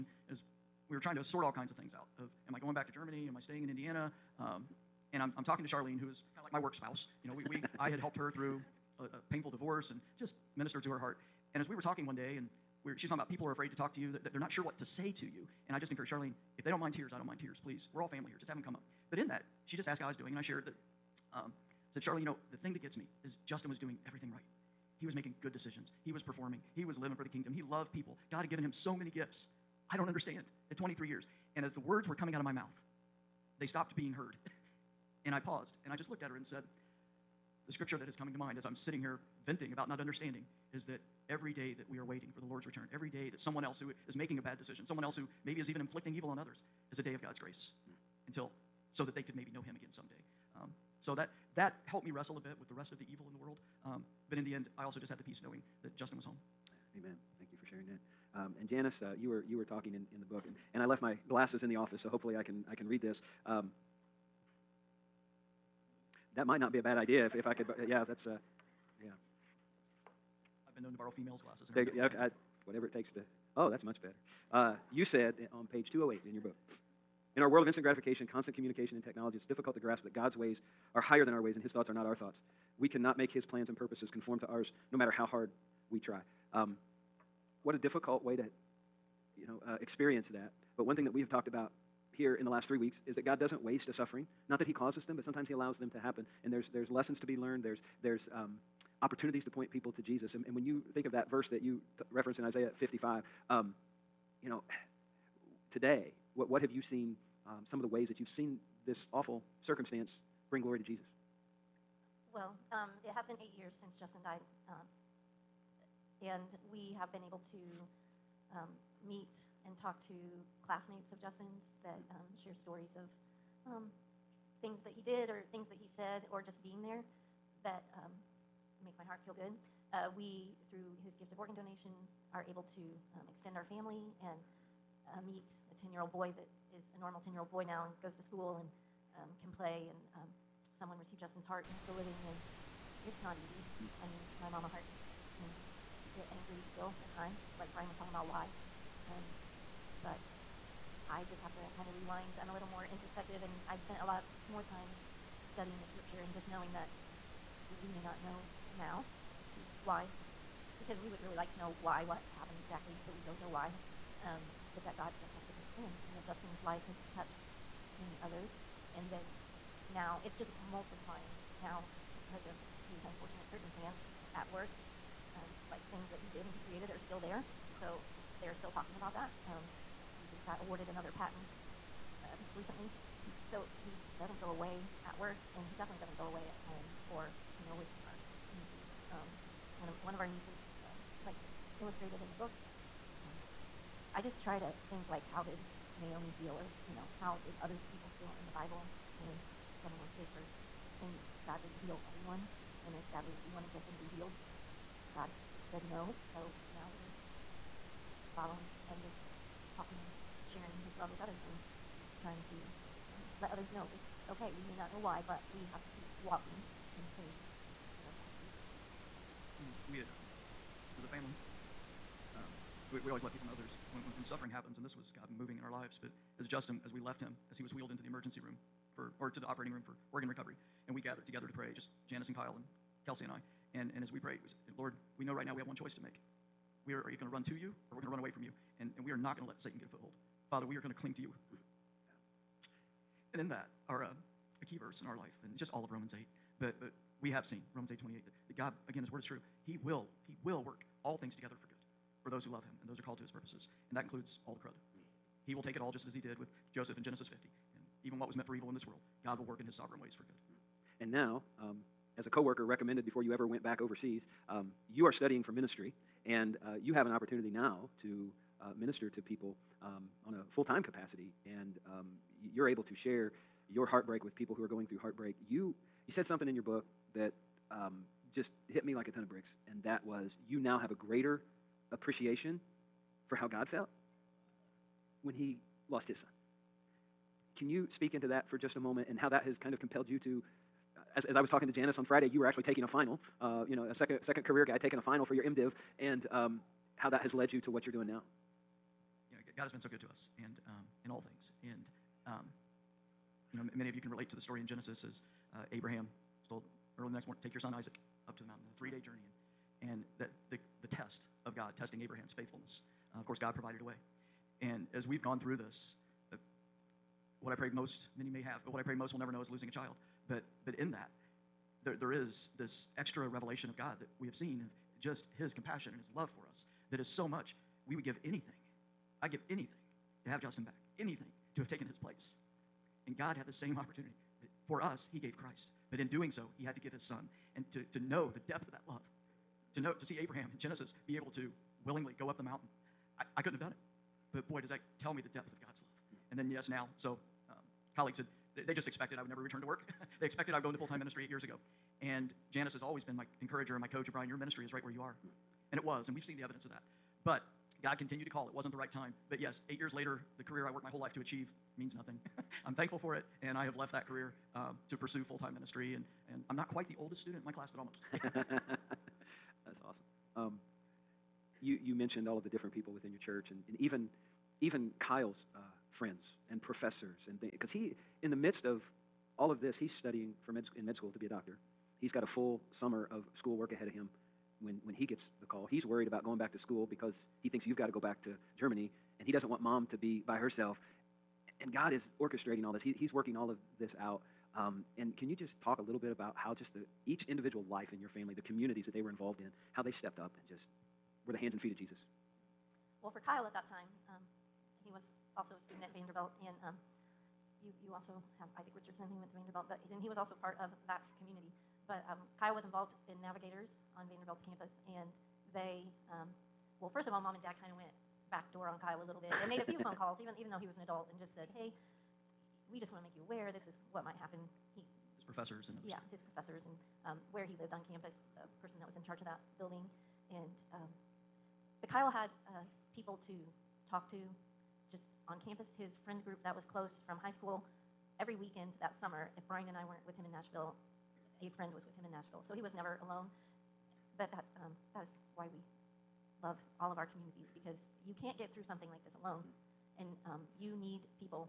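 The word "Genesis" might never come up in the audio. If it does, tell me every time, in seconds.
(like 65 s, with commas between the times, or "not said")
257 s, 304 s, 340 s.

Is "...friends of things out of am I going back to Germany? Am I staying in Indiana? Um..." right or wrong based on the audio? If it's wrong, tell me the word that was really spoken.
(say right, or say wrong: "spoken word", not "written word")
wrong: "kinds", not "friends".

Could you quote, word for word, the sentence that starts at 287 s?
Can you speak into that for just a moment and how that has kind of compelled you to?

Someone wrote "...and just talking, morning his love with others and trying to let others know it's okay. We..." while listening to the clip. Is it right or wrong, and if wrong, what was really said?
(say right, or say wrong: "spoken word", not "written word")
wrong: "sharing", not "morning".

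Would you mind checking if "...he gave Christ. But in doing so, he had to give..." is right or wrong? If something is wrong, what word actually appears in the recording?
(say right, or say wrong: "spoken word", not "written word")
right.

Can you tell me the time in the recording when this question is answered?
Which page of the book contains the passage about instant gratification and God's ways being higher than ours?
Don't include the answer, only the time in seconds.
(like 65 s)
75 s.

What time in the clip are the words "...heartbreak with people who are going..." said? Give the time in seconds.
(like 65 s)
273 s.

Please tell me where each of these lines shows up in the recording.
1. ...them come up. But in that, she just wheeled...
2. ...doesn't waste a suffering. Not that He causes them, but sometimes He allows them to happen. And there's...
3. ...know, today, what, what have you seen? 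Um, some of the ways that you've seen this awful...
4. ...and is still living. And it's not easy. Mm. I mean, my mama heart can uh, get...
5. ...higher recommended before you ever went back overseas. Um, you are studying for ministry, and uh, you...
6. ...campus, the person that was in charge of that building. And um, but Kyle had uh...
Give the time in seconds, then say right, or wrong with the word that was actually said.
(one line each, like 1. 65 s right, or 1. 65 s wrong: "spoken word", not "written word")
1. 18 s wrong: "asked", not "wheeled"
2. 93 s right
3. 104 s right
4. 141 s right
5. 262 s wrong: "coworker", not "higher"
6. 427 s right.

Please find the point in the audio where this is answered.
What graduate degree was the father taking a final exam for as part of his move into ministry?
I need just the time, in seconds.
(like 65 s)
295 s.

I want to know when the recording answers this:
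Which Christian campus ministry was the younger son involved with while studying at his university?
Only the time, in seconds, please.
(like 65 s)
413 s.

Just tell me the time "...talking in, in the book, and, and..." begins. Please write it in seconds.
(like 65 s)
59 s.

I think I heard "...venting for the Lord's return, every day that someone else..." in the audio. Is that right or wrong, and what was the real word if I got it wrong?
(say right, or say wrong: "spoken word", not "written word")
wrong: "waiting", not "venting".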